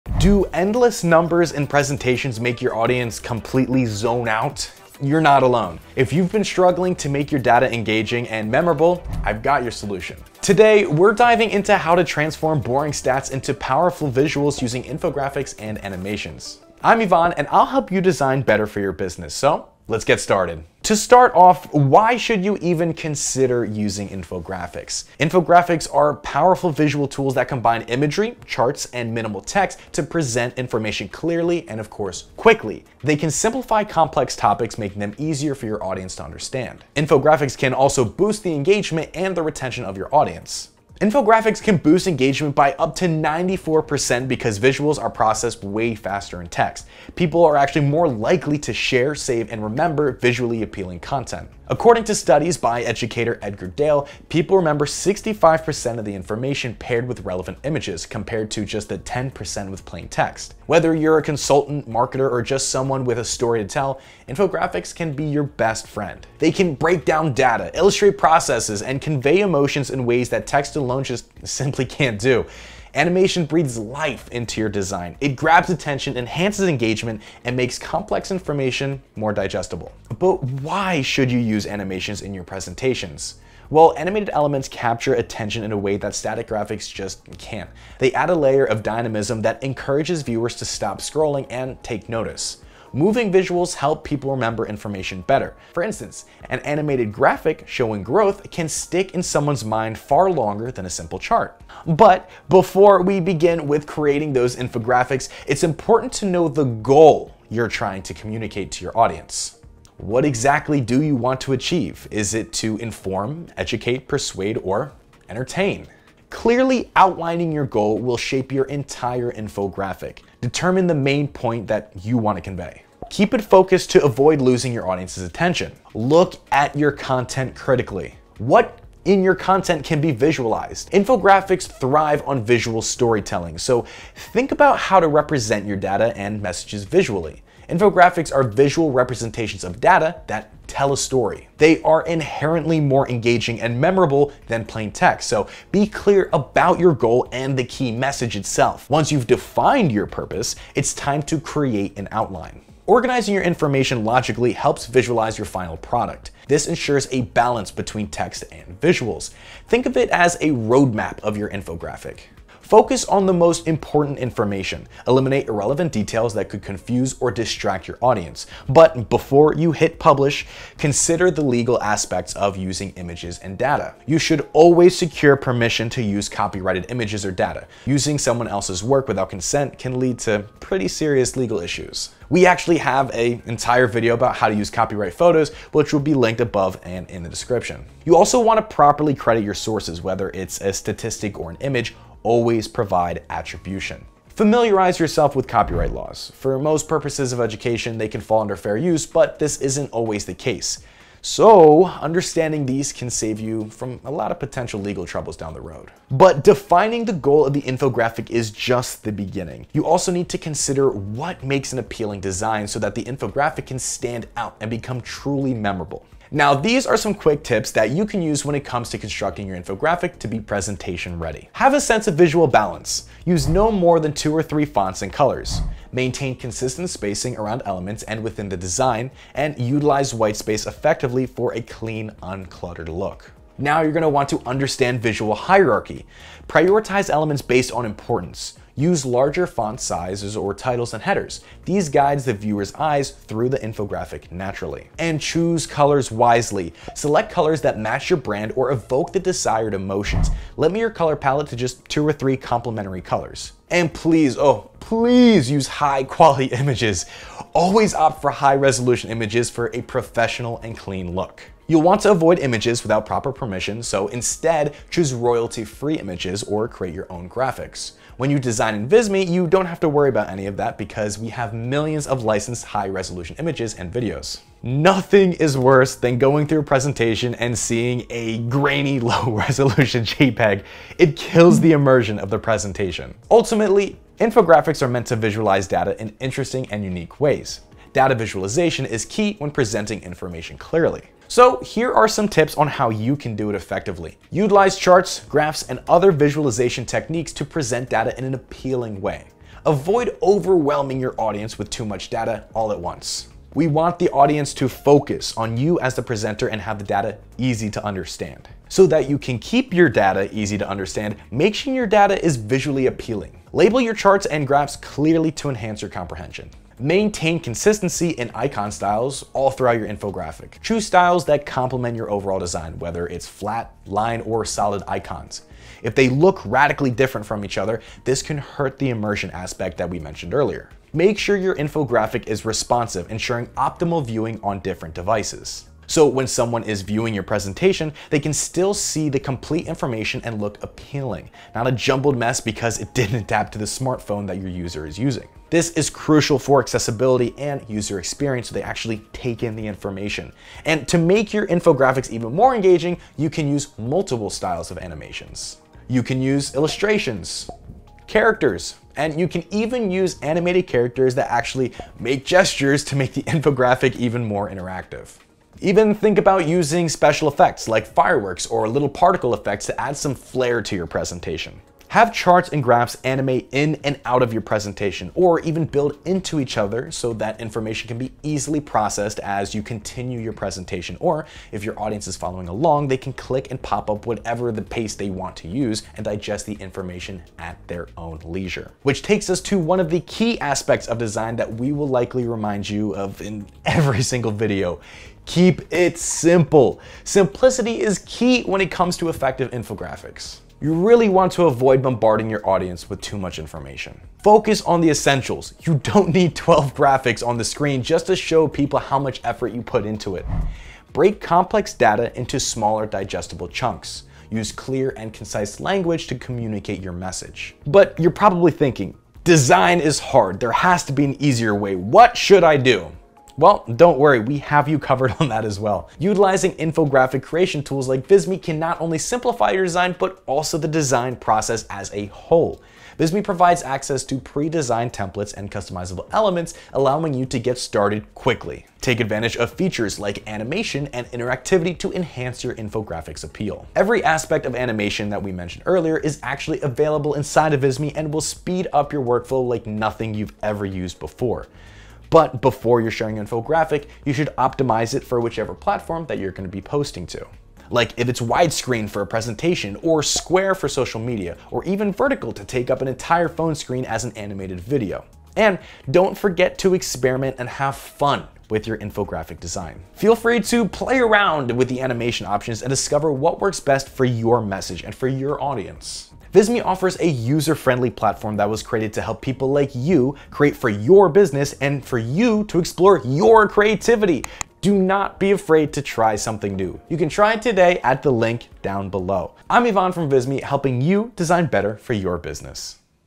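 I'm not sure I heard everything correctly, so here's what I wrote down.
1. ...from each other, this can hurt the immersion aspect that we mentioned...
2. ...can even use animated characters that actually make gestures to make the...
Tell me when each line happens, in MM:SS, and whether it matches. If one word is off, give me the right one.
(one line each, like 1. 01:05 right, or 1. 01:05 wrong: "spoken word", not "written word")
1. 05:27 right
2. 05:59 right.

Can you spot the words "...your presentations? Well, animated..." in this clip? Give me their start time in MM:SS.
01:22.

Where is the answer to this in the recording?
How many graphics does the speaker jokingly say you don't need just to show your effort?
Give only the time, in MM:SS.
06:46.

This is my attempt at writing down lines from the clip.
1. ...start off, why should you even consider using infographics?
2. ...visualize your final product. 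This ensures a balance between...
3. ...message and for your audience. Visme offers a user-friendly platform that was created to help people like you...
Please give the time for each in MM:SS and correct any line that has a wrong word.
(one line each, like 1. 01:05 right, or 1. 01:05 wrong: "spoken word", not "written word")
1. 00:20 right
2. 02:34 right
3. 07:54 right.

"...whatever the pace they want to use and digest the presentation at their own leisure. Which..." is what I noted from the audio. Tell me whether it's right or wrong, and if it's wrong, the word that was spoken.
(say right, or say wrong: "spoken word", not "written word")
wrong: "information", not "presentation".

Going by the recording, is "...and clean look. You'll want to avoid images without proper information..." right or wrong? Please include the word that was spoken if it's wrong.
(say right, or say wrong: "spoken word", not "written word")
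wrong: "permission", not "information".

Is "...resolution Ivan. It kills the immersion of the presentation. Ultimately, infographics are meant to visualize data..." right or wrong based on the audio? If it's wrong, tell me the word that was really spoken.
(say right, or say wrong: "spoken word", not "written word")
wrong: "JPEG", not "Ivan".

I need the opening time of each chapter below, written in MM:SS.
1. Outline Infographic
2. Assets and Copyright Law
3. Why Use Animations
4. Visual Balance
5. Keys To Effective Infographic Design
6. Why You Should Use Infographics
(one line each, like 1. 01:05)
1. 01:50
2. 02:54
3. 01:20
4. 03:36
5. 04:45
6. 00:22.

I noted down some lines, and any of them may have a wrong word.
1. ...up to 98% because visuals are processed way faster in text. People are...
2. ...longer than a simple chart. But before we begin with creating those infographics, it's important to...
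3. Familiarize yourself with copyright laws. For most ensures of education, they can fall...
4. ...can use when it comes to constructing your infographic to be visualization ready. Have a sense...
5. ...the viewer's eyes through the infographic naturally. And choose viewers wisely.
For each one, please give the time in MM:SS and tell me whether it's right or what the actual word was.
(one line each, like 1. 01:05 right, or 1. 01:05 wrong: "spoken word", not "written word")
1. 00:42 wrong: "94", not "98"
2. 01:40 right
3. 03:14 wrong: "purposes", not "ensures"
4. 03:38 wrong: "presentation", not "visualization"
5. 04:02 wrong: "colors", not "viewers".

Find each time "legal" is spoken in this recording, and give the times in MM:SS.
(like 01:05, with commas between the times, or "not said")
02:51, 03:01, 03:24.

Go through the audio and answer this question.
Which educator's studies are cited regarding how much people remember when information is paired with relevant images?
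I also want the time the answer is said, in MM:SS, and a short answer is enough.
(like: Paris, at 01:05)
Edgar Dale, at 00:53.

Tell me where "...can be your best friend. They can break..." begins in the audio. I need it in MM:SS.
01:04.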